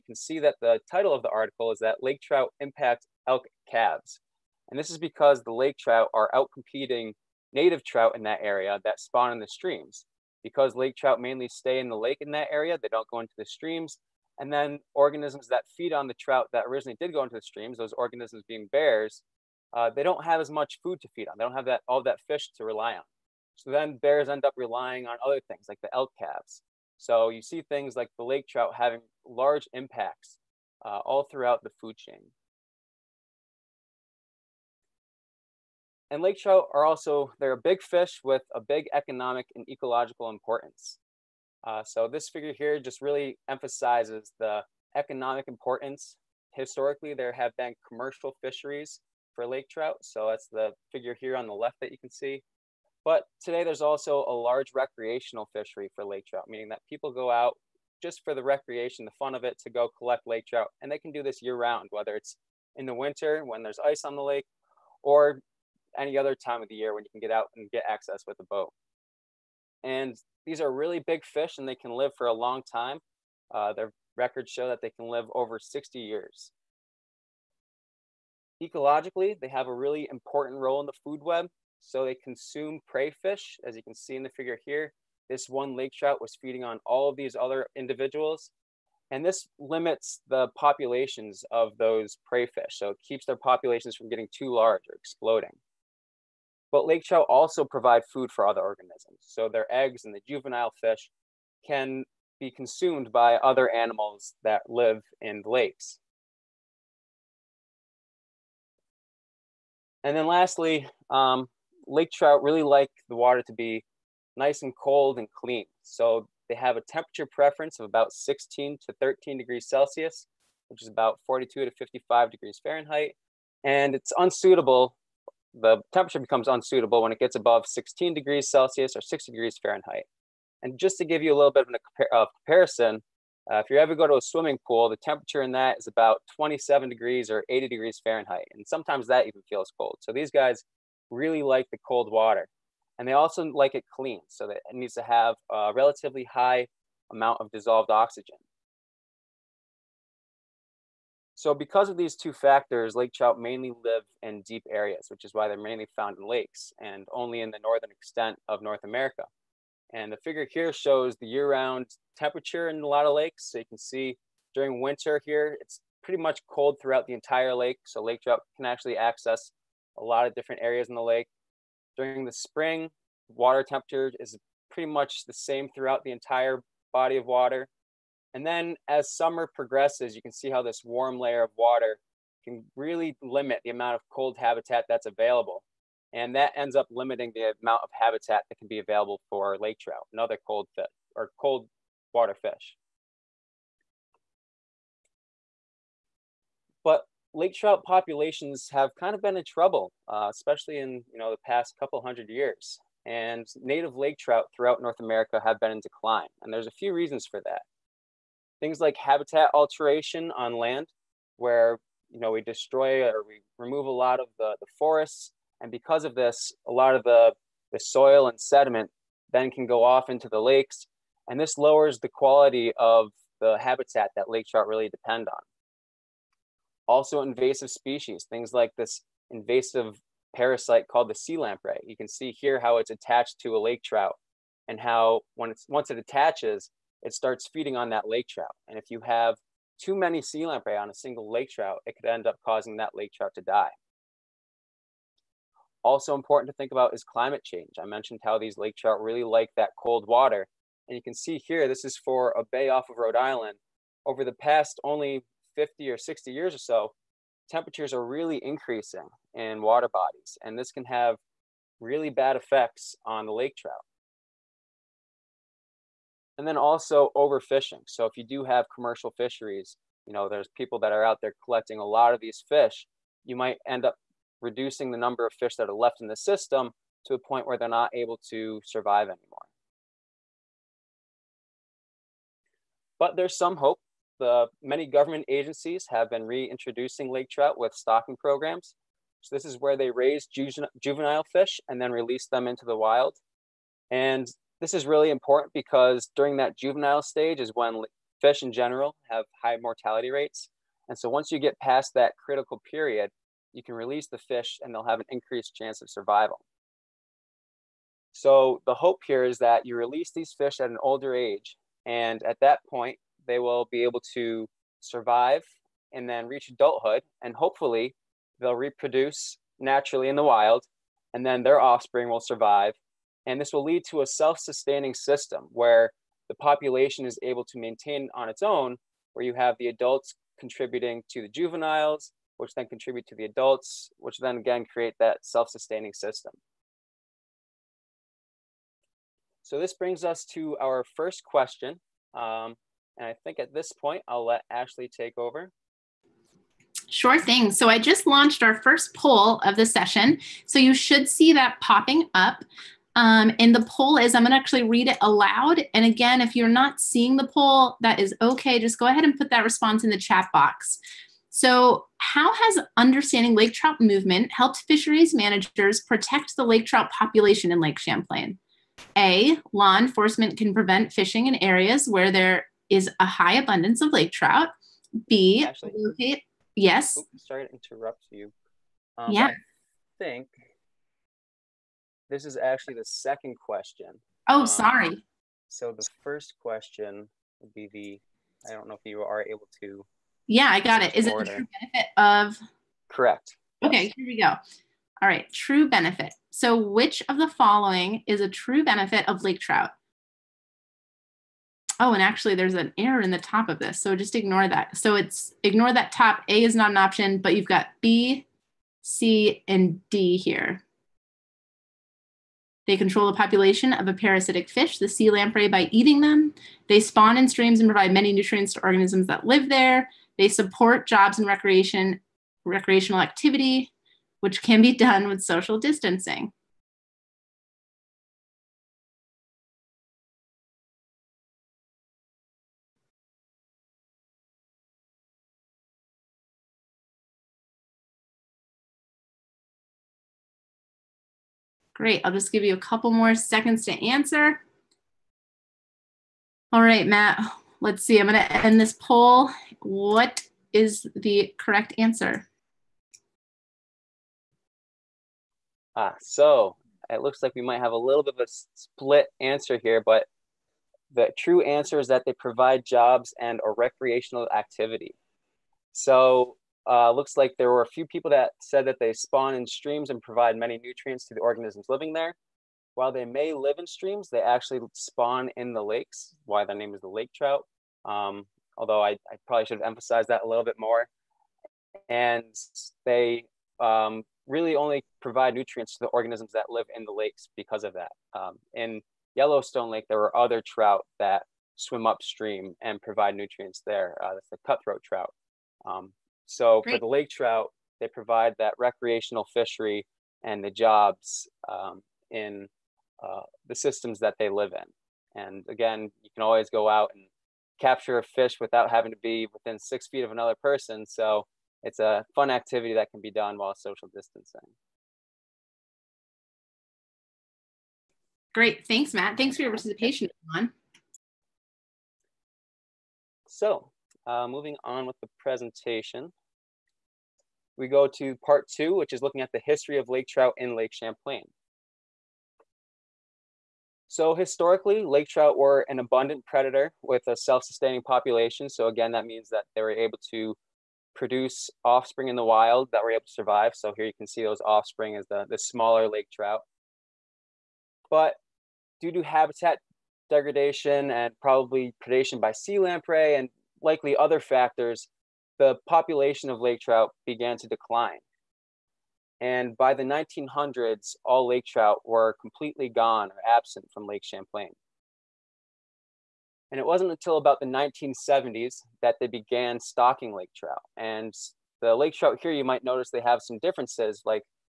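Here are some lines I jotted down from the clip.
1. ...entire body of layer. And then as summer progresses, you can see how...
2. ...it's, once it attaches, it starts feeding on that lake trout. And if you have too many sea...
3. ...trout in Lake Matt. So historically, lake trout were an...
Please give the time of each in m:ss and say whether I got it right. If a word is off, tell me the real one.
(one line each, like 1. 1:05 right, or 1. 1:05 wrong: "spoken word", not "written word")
1. 2:56 wrong: "water", not "layer"
2. 3:55 right
3. 8:50 wrong: "Champlain", not "Matt".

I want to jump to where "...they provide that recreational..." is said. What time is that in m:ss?
8:17.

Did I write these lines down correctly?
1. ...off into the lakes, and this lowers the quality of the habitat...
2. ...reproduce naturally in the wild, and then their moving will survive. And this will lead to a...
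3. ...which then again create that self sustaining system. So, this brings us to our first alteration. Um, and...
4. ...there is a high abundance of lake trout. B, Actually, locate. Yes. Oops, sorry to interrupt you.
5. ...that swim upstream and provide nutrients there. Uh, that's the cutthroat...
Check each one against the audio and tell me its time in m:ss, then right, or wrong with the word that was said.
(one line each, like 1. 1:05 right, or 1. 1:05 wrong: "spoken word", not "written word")
1. 3:39 right
2. 5:18 wrong: "offspring", not "moving"
3. 5:33 wrong: "question", not "alteration"
4. 6:12 right
5. 8:10 right.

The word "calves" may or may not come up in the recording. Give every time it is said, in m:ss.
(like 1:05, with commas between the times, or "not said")
0:03, 0:26.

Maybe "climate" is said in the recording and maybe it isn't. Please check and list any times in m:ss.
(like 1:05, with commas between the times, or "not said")
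4:07.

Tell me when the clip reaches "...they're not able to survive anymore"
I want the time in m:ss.
4:37.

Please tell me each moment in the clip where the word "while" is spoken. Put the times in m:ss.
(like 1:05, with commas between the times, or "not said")
7:52, 8:33.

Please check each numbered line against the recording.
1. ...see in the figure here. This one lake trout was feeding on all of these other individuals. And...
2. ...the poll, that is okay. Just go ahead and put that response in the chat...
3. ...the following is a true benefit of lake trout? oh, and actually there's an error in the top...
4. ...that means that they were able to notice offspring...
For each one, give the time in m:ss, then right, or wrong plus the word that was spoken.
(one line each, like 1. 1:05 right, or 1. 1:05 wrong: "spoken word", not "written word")
1. 1:23 right
2. 5:57 right
3. 6:37 right
4. 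8:58 wrong: "produce", not "notice".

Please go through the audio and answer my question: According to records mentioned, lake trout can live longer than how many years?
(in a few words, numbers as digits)
60 years.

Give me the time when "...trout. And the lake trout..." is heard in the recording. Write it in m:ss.
9:30.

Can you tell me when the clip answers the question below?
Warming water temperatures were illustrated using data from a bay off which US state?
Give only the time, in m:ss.
4:12.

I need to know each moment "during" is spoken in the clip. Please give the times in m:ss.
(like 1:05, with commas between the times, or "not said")
2:44, 2:51, 4:56.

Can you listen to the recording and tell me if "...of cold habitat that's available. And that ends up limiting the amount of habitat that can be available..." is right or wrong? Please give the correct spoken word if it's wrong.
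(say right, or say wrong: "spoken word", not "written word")
right.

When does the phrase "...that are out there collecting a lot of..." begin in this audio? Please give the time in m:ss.
4:30.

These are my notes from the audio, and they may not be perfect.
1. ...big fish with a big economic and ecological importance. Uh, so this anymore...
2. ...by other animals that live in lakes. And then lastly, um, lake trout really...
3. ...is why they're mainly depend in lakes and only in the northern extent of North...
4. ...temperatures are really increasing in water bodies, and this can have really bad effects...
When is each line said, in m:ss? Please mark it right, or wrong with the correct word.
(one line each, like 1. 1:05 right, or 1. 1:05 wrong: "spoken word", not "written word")
1. 0:37 wrong: "figure", not "anymore"
2. 1:43 right
3. 2:35 wrong: "found", not "depend"
4. 4:17 right.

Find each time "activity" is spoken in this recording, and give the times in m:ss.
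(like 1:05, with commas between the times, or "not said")
7:03, 7:44, 8:32.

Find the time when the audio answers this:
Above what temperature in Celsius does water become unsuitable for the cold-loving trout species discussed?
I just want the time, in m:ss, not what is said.
2:07.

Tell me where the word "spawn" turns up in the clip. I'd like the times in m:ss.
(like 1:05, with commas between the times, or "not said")
0:09, 6:56, 7:48, 7:54.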